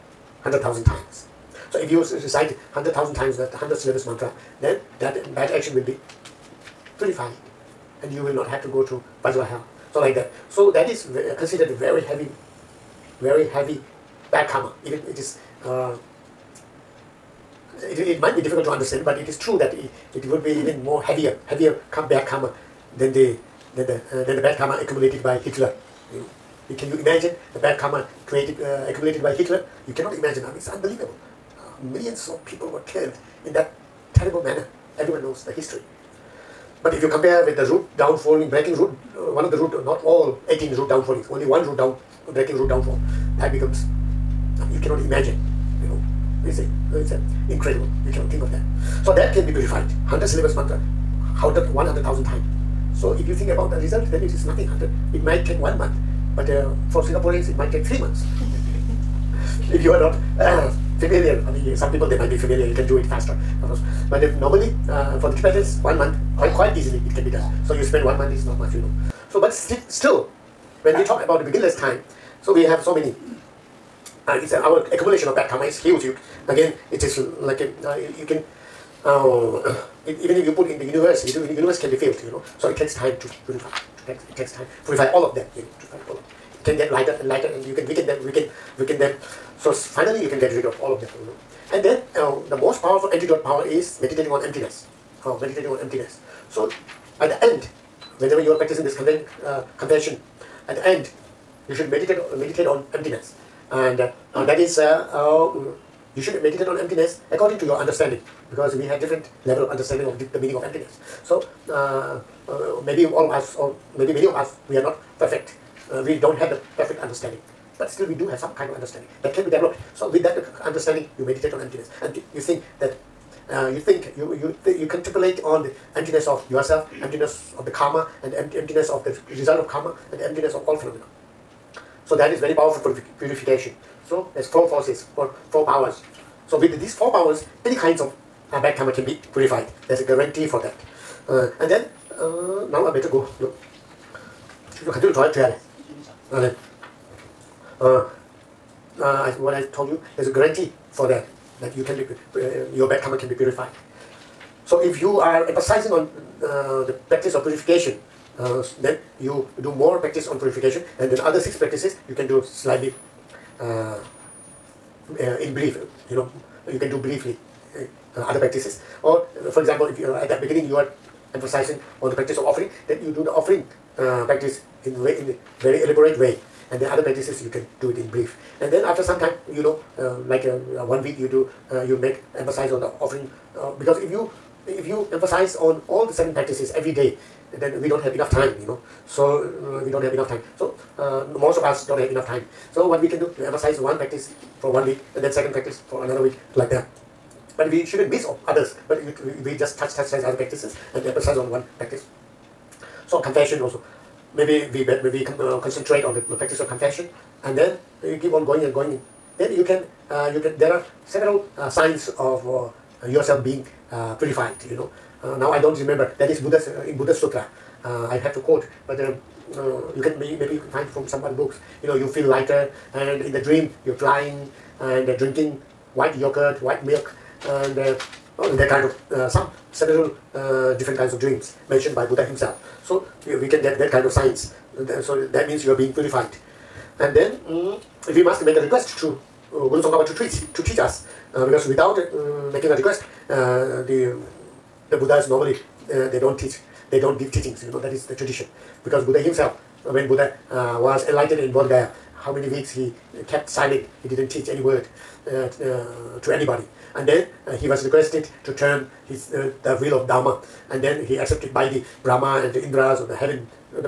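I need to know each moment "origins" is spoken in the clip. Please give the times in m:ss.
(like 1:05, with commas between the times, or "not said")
not said.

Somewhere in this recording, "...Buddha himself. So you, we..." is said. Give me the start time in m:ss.
3:52.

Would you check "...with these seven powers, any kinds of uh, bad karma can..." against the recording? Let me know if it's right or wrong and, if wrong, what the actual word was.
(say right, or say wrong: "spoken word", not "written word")
wrong: "four", not "seven".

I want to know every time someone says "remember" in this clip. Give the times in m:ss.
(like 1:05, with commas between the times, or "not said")
3:35.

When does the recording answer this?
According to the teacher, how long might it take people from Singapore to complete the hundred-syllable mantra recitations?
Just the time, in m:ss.
0:57.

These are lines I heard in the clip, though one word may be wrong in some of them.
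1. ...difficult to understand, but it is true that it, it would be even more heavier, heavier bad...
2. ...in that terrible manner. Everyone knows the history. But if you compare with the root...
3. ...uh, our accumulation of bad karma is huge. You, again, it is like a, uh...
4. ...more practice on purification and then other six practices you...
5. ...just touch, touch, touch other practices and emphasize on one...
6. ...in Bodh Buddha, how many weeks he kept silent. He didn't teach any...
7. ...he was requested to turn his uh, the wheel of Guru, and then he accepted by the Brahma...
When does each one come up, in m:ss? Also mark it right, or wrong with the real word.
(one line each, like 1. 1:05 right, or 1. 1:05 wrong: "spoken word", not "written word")
1. 0:18 right
2. 0:33 right
3. 1:14 right
4. 2:39 right
5. 3:19 right
6. 4:11 wrong: "Gaya", not "Buddha"
7. 4:17 wrong: "Dharma", not "Guru".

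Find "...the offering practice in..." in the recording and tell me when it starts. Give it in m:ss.
2:53.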